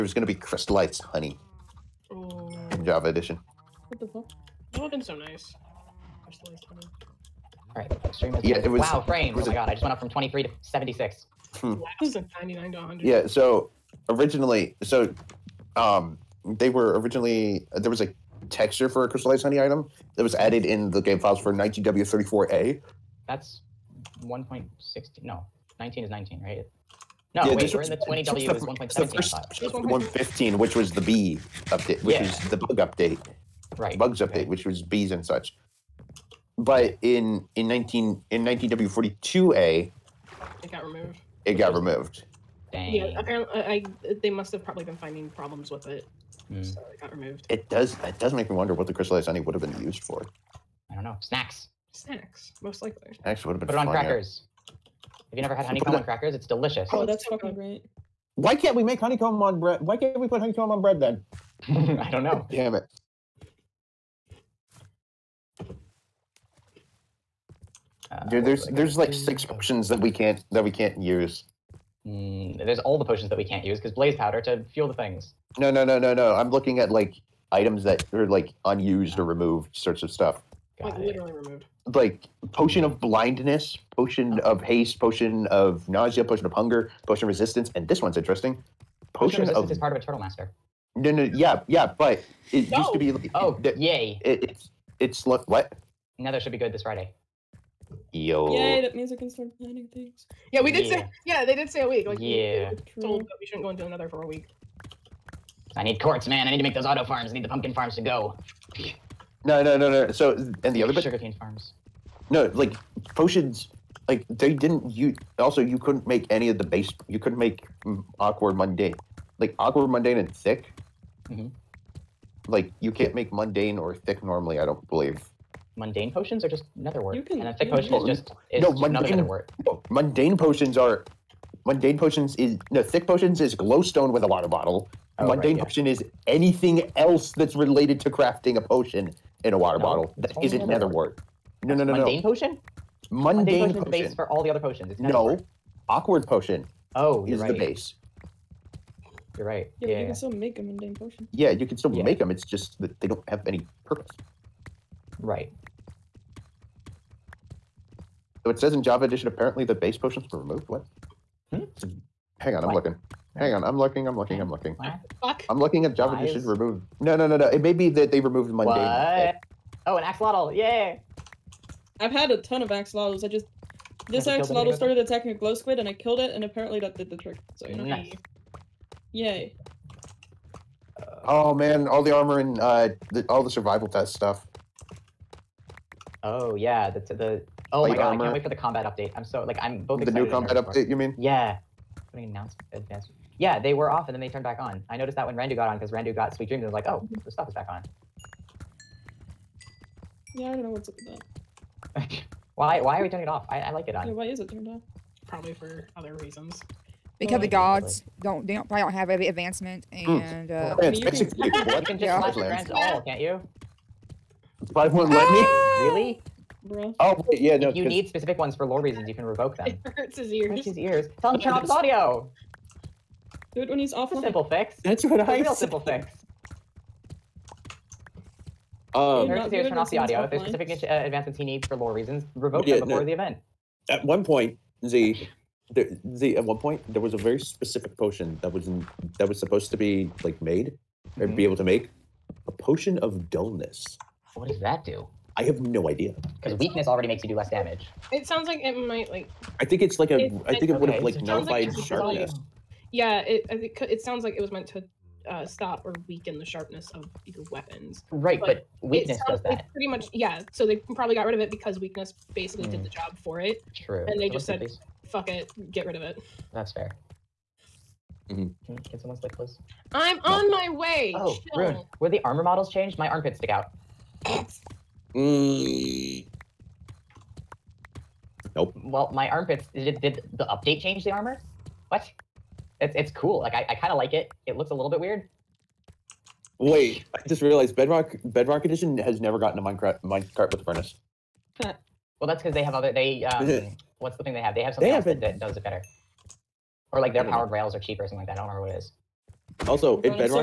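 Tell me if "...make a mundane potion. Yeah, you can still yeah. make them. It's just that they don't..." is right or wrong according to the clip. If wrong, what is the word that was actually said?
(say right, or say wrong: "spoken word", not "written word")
right.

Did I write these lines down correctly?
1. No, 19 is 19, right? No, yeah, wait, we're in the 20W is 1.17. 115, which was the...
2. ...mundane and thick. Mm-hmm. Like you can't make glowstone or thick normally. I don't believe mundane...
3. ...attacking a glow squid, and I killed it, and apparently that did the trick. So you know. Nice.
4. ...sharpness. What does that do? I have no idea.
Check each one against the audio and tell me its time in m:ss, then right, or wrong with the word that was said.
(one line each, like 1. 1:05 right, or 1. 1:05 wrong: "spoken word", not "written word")
1. 0:25 right
2. 1:59 wrong: "mundane", not "glowstone"
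3. 2:54 right
4. 4:03 wrong: "dullness", not "sharpness".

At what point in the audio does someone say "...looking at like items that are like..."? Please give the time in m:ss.
1:16.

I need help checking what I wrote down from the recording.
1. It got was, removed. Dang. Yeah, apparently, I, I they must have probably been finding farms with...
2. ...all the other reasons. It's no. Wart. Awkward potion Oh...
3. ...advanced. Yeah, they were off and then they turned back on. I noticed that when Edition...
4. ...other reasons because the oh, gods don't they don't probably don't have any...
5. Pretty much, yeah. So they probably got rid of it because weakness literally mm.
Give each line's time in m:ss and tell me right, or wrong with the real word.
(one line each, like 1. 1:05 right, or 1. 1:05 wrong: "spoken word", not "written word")
1. 0:41 wrong: "problems", not "farms"
2. 2:24 wrong: "potions", not "reasons"
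3. 3:12 wrong: "Randu", not "Edition"
4. 3:25 right
5. 4:19 wrong: "basically", not "literally".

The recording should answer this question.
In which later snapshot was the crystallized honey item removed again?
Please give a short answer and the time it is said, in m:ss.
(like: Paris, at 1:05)
19W42A, at 0:38.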